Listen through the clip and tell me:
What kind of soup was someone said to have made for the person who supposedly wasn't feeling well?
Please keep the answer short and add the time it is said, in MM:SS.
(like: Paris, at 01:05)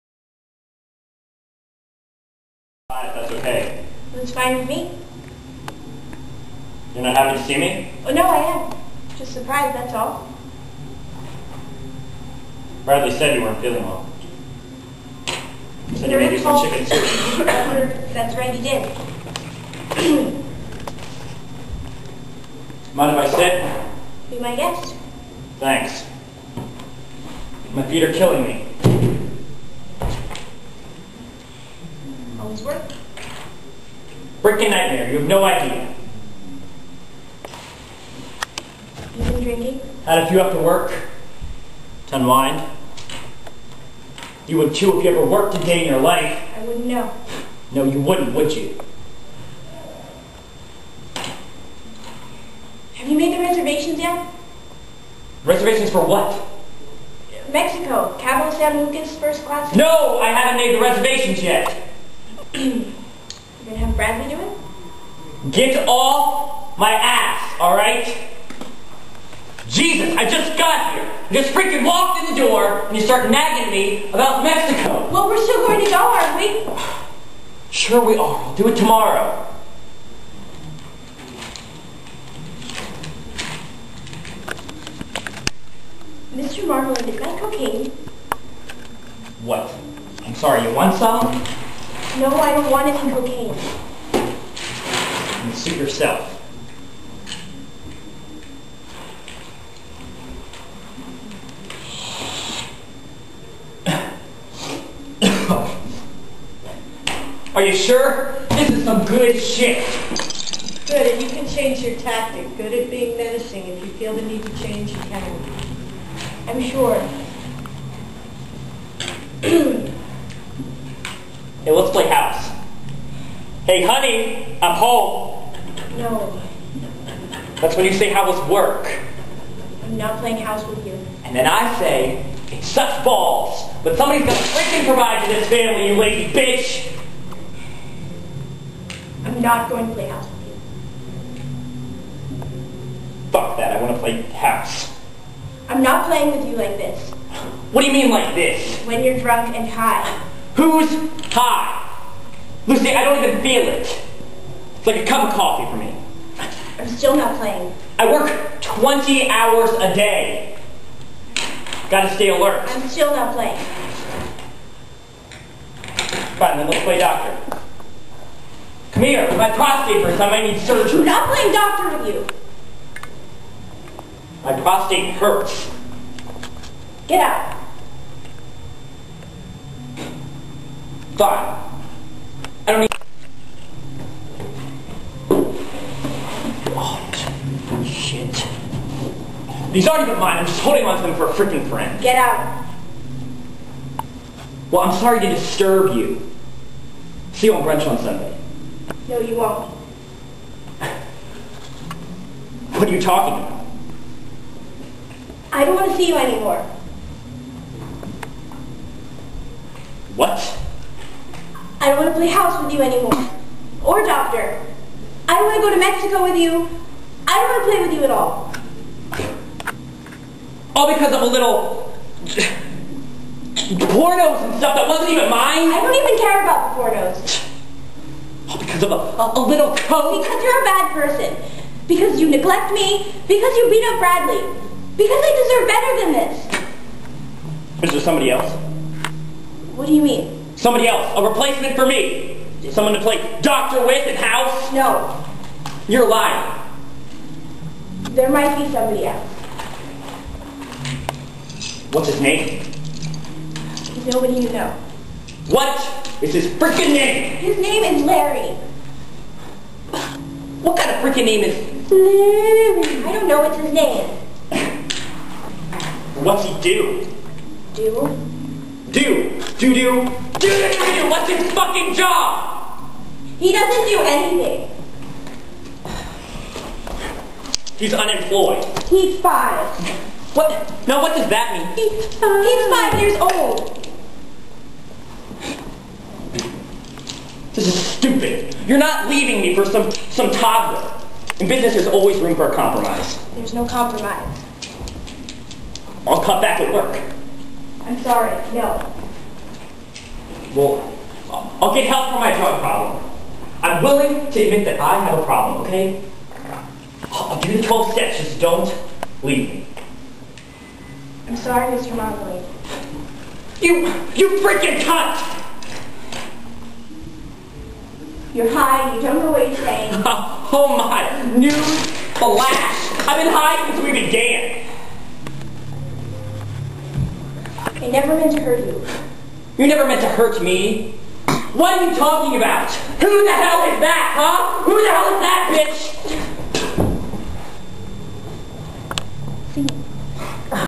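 Chicken soup, at 00:16.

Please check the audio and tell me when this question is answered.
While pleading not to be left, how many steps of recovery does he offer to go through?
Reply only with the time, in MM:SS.
05:07.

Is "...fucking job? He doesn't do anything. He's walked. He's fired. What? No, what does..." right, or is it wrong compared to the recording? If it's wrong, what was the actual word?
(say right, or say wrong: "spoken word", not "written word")
wrong: "unemployed", not "walked".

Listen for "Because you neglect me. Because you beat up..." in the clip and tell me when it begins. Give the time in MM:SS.
03:51.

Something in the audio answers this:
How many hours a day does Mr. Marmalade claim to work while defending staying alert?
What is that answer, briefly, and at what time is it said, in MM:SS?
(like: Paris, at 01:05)
20, at 02:38.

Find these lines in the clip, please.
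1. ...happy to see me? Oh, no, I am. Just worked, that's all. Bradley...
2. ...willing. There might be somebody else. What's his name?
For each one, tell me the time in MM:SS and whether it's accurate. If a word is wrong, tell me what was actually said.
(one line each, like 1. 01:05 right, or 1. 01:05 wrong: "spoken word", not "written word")
1. 00:07 wrong: "surprised", not "worked"
2. 04:06 wrong: "lying", not "willing".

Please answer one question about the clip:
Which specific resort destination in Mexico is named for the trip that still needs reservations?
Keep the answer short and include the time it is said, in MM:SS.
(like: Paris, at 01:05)
Cabo San Lucas, at 00:58.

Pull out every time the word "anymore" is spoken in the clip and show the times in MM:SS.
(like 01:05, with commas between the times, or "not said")
03:26, 03:32.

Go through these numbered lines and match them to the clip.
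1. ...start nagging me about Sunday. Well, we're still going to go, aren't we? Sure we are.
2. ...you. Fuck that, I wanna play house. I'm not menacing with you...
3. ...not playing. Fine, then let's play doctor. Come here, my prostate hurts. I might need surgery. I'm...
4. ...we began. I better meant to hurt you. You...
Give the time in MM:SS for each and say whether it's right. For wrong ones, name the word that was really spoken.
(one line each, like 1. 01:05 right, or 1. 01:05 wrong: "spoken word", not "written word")
1. 01:13 wrong: "Mexico", not "Sunday"
2. 02:22 wrong: "playing", not "menacing"
3. 02:43 right
4. 05:23 wrong: "never", not "better".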